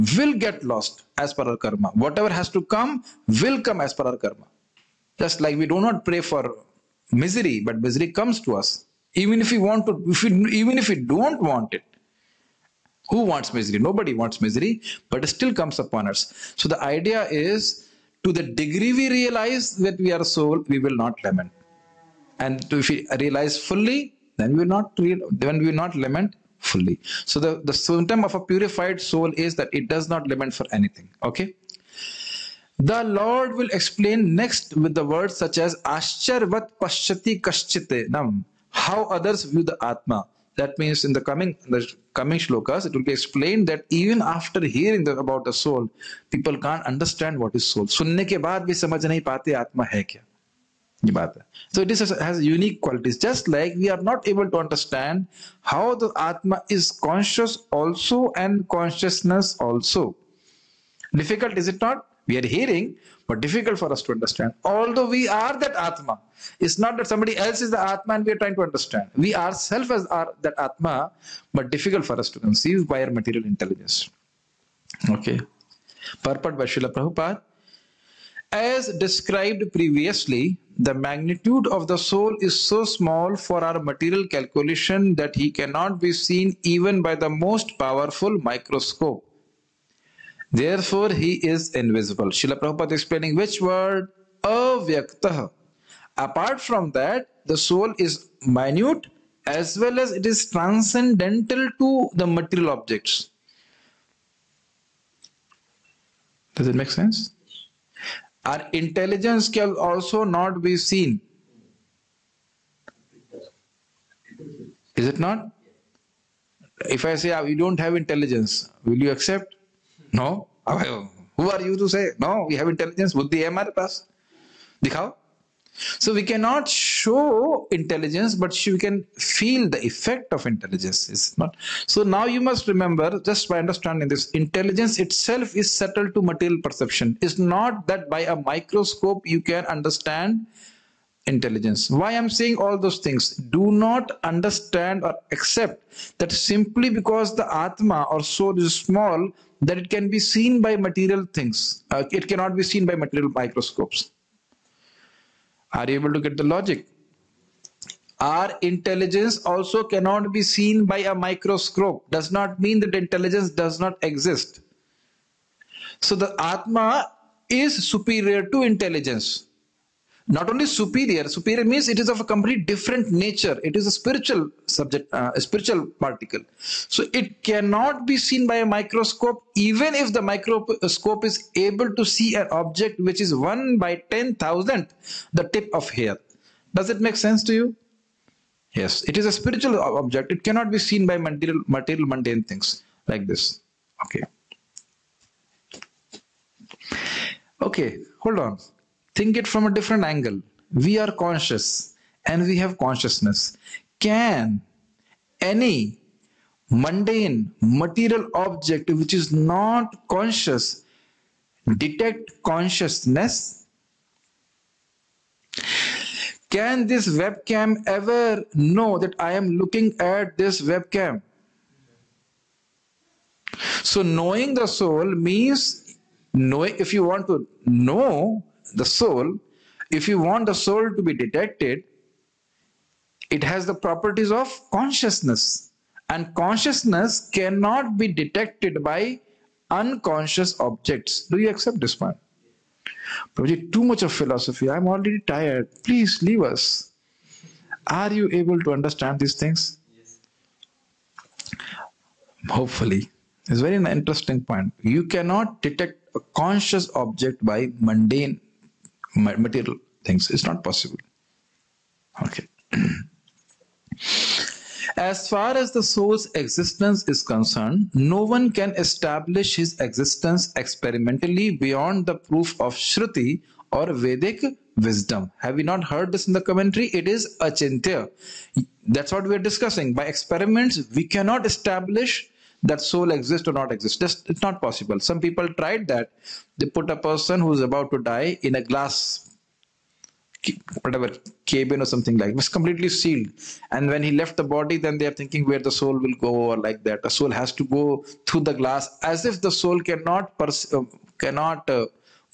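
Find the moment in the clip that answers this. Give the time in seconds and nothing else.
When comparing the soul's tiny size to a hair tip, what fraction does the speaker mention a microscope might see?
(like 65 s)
183 s.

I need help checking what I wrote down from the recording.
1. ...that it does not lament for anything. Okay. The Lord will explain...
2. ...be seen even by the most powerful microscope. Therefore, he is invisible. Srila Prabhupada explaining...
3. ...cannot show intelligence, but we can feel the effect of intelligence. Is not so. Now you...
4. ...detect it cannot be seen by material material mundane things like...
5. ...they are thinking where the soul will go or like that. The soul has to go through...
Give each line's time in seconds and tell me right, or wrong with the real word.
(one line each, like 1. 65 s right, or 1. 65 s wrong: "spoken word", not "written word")
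1. 29 s right
2. 86 s right
3. 126 s right
4. 190 s wrong: "object", not "detect"
5. 294 s right.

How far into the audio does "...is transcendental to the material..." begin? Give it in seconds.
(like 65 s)
100 s.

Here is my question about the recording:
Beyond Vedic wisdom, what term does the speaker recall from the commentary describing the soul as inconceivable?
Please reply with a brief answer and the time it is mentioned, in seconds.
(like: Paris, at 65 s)
achintya, at 277 s.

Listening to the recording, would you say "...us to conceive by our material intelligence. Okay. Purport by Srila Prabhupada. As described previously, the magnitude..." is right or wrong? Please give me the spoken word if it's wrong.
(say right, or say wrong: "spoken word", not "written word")
right.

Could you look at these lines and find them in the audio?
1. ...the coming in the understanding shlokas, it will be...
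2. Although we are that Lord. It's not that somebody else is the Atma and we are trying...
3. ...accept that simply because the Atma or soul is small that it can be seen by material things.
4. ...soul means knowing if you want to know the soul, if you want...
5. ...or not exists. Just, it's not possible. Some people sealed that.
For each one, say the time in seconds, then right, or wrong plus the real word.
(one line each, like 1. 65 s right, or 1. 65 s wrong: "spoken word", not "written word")
1. 41 s wrong: "coming", not "understanding"
2. 64 s wrong: "Atma", not "Lord"
3. 145 s right
4. 224 s right
5. 283 s wrong: "tried", not "sealed".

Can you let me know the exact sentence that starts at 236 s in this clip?
And consciousness cannot be detected by unconscious objects.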